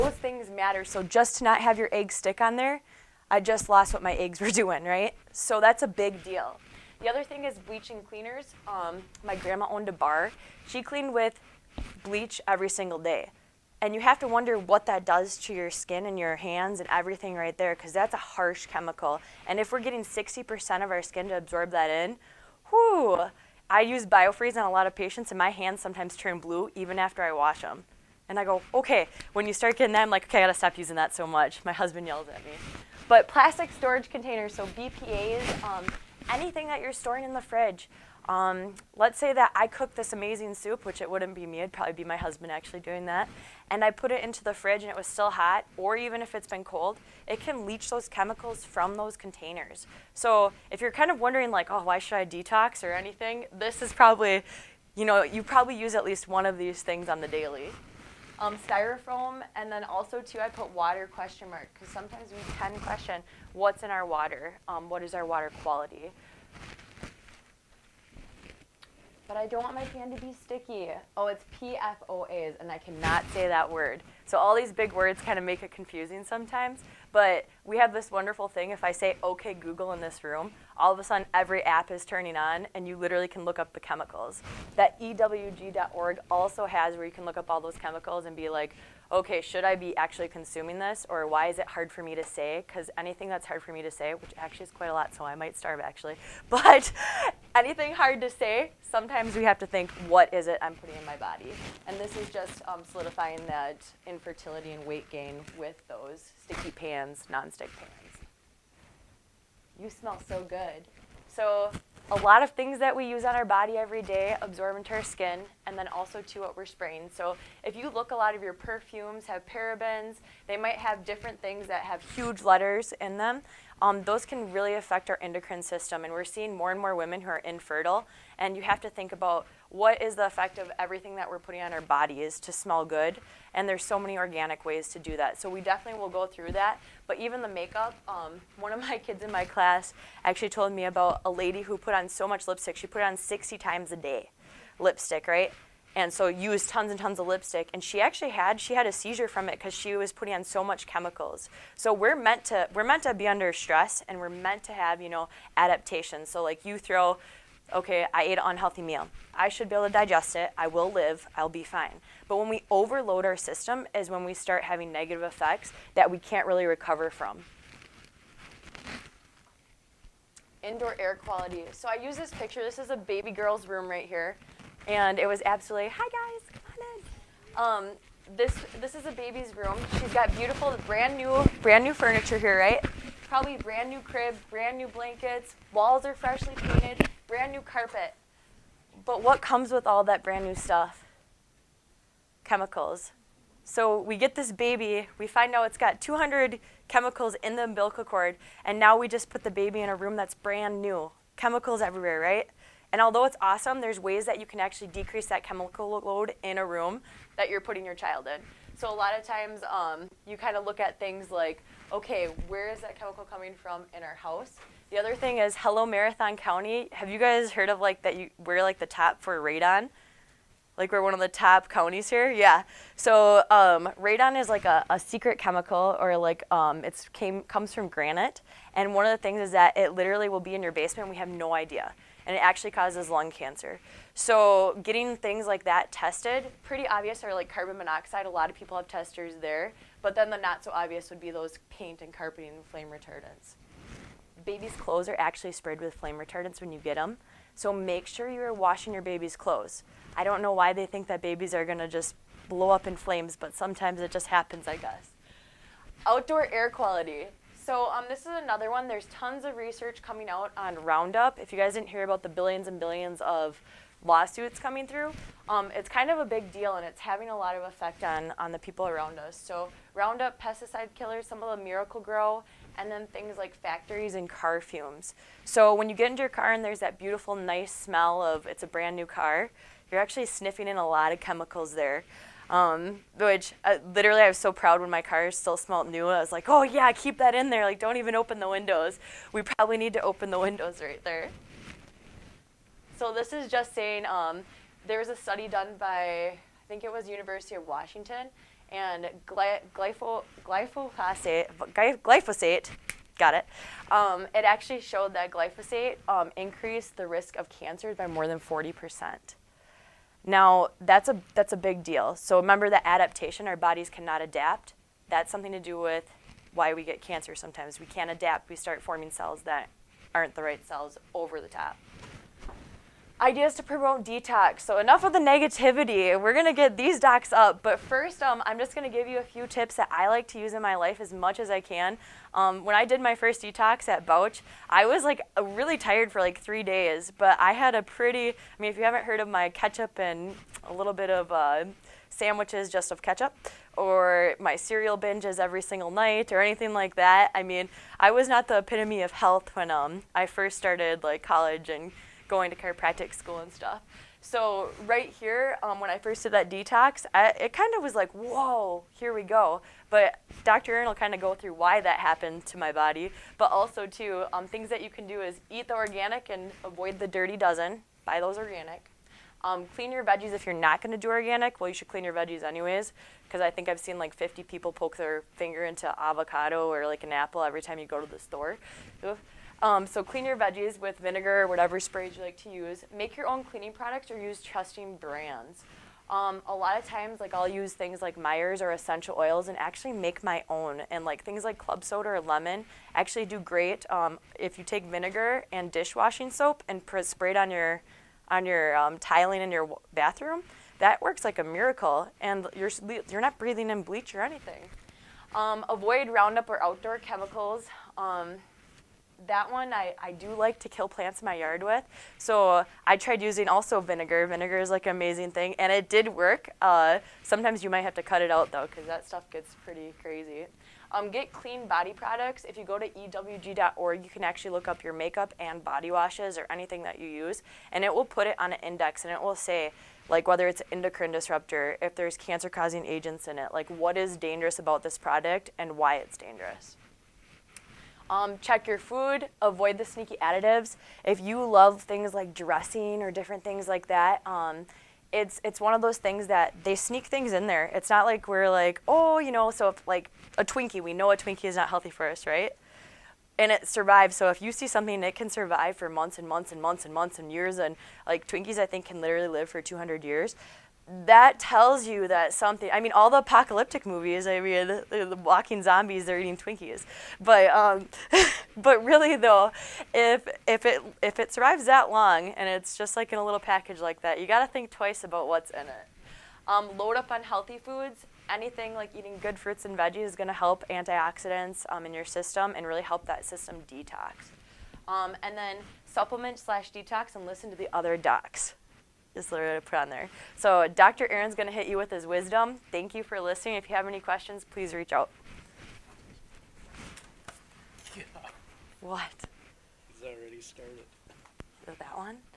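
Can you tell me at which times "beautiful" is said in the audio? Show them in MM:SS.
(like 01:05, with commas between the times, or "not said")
03:00, 04:36.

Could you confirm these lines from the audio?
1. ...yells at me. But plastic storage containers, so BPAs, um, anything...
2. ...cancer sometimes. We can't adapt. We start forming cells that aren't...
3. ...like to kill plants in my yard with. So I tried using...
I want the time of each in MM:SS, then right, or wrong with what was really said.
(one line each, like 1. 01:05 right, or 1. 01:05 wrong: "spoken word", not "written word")
1. 00:32 right
2. 05:16 right
3. 06:50 right.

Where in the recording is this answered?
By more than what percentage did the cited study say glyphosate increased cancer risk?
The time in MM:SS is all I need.
05:08.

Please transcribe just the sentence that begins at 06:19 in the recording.
Um, so clean your veggies with vinegar or whatever sprays you like to use.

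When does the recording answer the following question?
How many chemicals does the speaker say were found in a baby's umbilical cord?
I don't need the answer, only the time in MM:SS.
03:15.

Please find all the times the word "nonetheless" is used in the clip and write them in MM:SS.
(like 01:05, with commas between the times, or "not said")
not said.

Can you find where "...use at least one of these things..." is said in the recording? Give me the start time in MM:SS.
00:55.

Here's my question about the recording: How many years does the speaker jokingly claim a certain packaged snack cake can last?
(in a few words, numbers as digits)
200 years.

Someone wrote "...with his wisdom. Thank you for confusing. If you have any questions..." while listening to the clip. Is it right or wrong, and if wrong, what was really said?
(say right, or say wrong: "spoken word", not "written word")
wrong: "listening", not "confusing".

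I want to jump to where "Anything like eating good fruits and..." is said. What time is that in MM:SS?
07:58.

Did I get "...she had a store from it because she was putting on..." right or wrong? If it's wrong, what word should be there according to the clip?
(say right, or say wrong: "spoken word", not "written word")
wrong: "seizure", not "store".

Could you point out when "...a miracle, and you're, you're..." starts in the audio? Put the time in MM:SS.
06:41.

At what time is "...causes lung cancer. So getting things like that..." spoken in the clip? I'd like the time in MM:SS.
03:52.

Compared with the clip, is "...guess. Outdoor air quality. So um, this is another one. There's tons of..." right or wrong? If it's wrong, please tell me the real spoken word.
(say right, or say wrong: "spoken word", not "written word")
right.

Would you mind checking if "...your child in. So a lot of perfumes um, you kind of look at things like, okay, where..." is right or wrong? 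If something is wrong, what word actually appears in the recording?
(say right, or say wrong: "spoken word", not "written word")
wrong: "times", not "perfumes".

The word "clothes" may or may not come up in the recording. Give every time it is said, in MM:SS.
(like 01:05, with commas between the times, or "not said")
04:04, 04:09.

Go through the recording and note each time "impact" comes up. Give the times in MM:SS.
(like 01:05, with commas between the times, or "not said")
not said.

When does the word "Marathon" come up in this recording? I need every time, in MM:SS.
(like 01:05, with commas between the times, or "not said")
03:35.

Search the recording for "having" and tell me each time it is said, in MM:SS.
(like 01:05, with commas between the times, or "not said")
02:44, 04:27.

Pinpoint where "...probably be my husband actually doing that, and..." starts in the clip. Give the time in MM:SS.
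00:41.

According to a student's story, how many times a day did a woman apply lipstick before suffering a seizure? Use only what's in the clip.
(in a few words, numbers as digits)
60.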